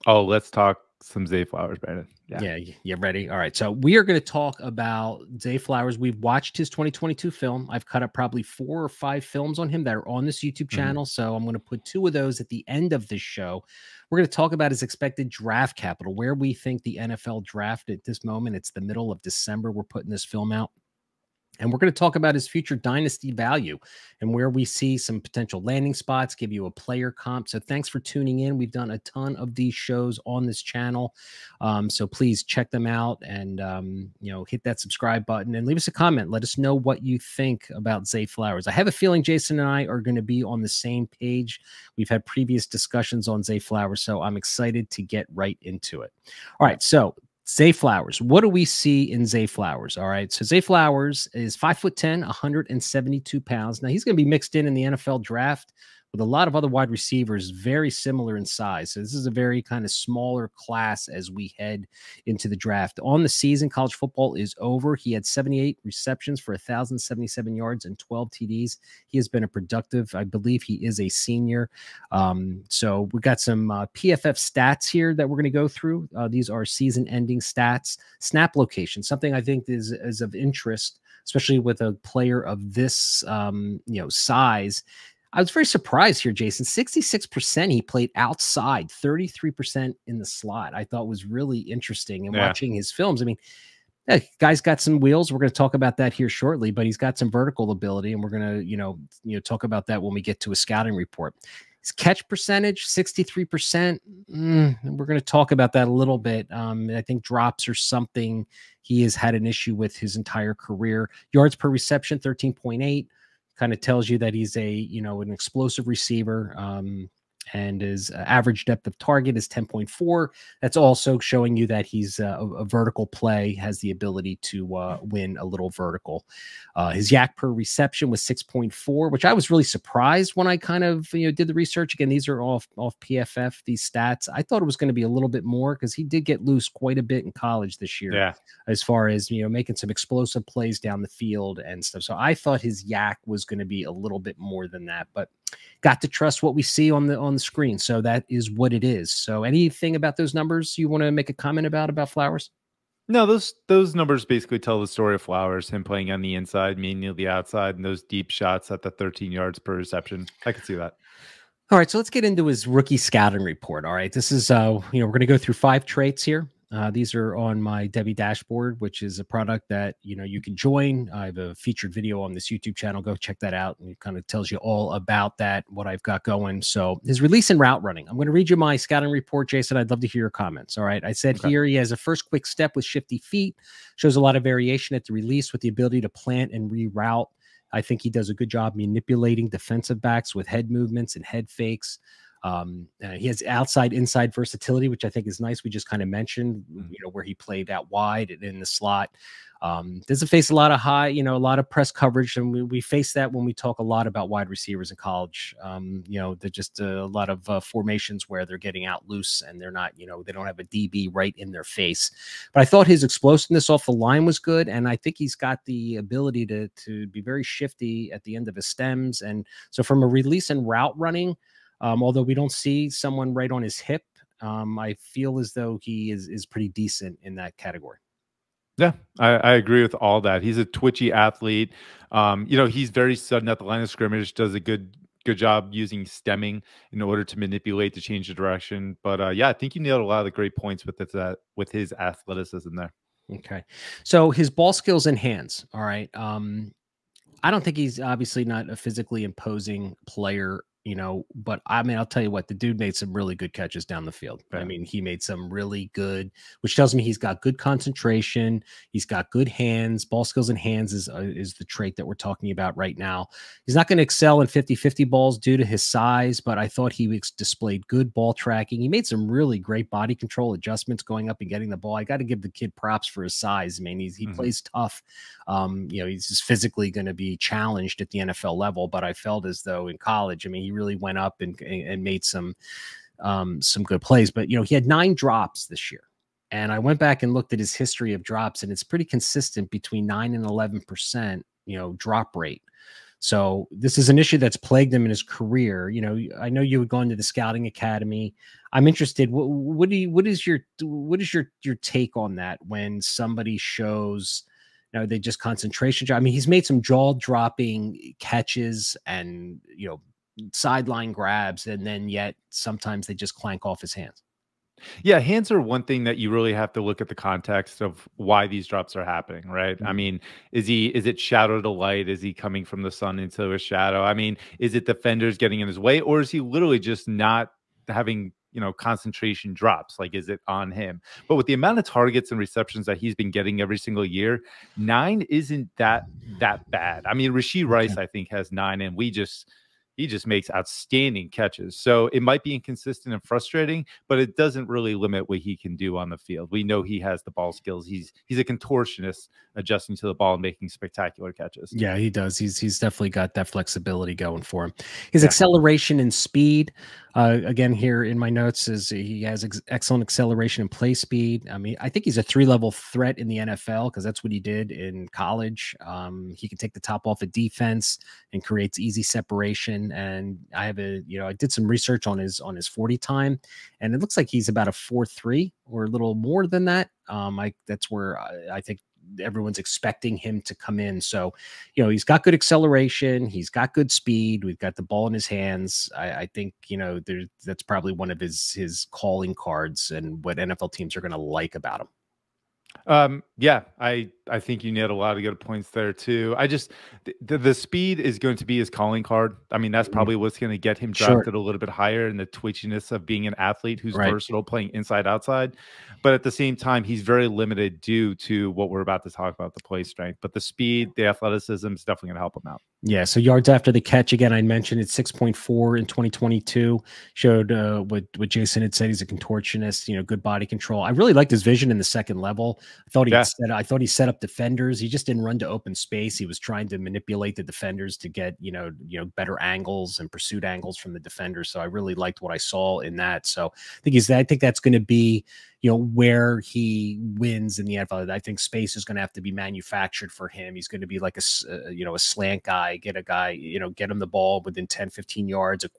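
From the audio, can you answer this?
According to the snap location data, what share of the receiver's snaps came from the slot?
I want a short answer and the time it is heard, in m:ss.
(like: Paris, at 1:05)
33%, at 1:28.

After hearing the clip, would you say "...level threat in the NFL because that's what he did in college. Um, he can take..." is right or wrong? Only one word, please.
right.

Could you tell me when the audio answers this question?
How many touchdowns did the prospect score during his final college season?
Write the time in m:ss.
1:07.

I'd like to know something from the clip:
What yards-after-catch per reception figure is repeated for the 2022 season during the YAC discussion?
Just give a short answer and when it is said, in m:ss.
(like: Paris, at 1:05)
6.4, at 6:54.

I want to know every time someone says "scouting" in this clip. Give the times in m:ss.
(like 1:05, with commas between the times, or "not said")
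1:40, 2:42, 2:58, 4:57.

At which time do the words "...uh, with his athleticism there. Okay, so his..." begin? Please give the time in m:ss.
4:01.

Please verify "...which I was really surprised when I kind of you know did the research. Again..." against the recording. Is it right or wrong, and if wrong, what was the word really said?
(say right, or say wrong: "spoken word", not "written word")
right.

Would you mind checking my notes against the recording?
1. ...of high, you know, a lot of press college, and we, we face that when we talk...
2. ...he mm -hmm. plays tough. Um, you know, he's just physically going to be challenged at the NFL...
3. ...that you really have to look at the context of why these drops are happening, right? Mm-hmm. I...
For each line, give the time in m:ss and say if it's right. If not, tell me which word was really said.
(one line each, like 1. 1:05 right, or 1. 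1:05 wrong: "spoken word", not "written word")
1. 3:20 wrong: "coverage", not "college"
2. 4:34 right
3. 5:16 right.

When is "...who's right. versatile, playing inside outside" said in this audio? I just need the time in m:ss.
6:43.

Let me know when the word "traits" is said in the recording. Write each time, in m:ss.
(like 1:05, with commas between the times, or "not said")
2:45, 4:21.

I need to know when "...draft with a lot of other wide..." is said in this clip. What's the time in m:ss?
0:55.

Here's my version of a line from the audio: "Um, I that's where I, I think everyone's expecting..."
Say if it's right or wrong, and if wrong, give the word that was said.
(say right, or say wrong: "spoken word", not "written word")
right.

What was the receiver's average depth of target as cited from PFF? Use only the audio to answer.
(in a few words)
10.4.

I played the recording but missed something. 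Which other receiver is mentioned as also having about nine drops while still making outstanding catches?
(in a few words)
Rashee Rice.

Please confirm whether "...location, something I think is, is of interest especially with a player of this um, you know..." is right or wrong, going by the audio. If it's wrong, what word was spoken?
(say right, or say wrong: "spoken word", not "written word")
right.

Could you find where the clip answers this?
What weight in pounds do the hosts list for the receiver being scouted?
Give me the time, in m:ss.
0:52.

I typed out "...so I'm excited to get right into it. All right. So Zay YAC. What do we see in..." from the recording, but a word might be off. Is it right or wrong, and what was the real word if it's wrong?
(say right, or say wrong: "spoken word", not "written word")
wrong: "Flowers", not "YAC".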